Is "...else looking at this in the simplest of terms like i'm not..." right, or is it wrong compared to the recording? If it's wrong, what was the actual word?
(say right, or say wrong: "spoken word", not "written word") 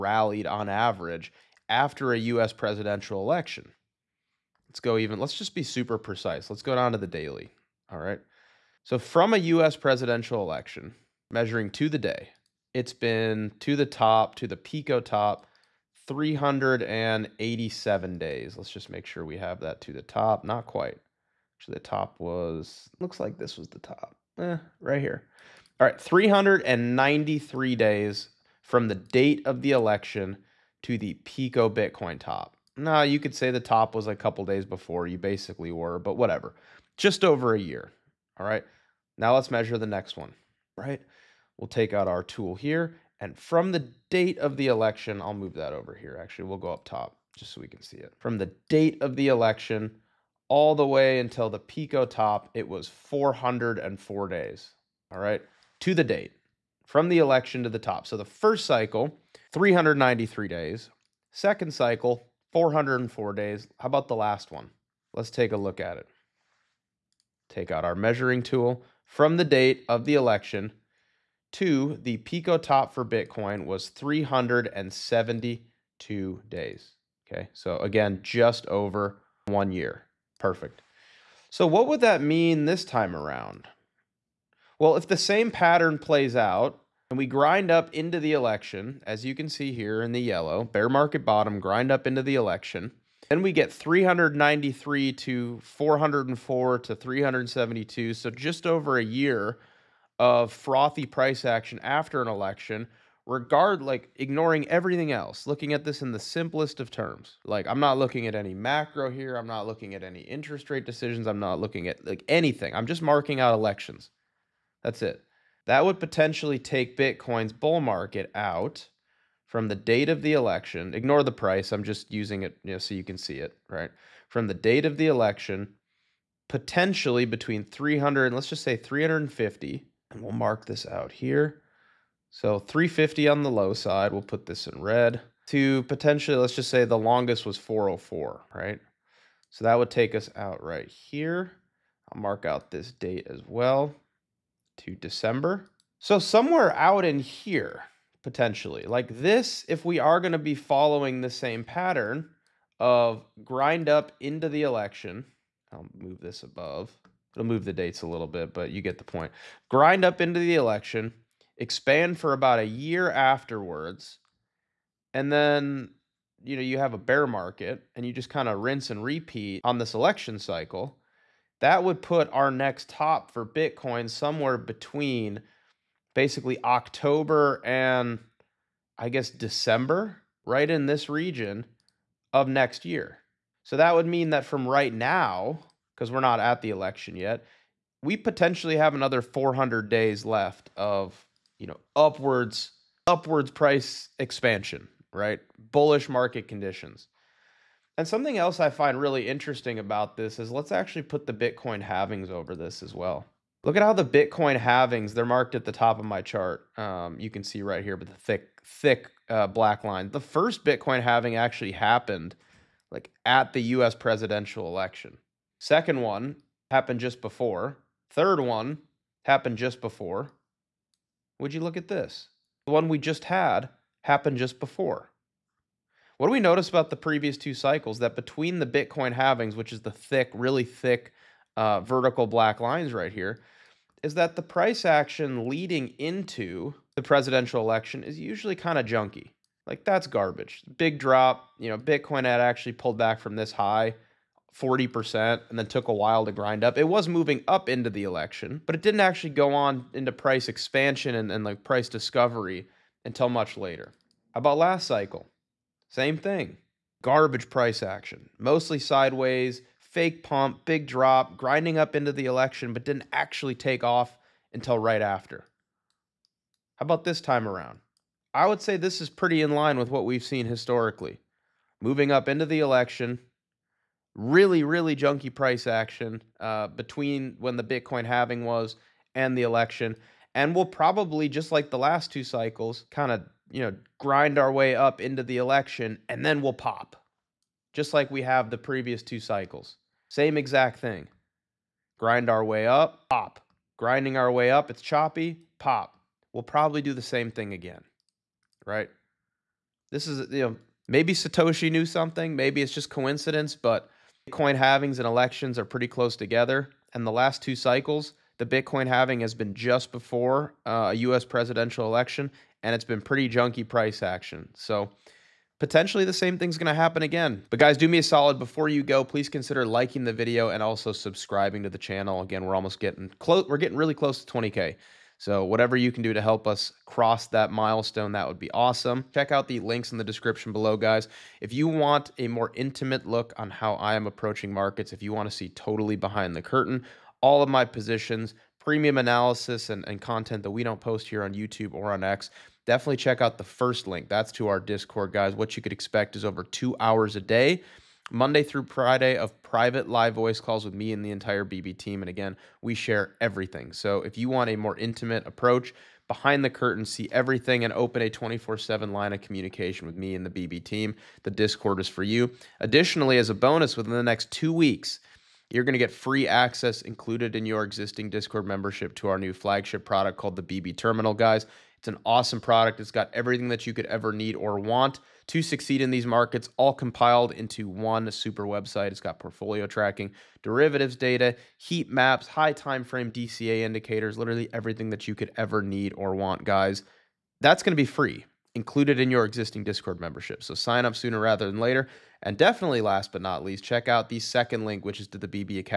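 right.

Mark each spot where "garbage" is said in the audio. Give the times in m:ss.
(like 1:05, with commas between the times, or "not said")
4:00, 4:17.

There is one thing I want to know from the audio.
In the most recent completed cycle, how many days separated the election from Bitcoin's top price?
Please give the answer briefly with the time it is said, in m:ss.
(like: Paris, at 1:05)
372, at 1:13.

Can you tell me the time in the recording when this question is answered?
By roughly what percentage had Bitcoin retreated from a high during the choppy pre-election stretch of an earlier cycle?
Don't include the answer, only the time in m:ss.
4:04.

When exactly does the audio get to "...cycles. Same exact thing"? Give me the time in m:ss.
4:49.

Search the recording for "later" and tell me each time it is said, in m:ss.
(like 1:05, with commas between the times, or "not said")
4:13, 6:31.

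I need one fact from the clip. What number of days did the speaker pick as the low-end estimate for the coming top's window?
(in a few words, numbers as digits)
350.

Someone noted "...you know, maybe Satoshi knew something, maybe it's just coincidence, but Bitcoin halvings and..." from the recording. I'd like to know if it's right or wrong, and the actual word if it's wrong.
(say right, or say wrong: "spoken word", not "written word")
right.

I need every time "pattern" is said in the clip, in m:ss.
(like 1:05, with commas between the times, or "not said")
1:25, 2:31.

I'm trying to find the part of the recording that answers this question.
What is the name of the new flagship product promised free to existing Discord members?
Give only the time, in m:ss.
6:10.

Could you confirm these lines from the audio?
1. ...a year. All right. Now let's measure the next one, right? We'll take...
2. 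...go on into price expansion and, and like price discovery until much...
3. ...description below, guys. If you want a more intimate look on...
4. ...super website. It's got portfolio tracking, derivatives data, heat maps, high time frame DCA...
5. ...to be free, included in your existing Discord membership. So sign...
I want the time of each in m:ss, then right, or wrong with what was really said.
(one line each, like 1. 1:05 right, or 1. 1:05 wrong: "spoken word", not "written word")
1. 0:37 right
2. 4:09 right
3. 5:30 right
4. 6:18 right
5. 6:27 right.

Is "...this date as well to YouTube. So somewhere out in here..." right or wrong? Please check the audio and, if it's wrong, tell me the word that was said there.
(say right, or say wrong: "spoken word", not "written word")
wrong: "December", not "YouTube".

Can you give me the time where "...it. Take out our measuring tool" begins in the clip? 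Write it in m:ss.
1:05.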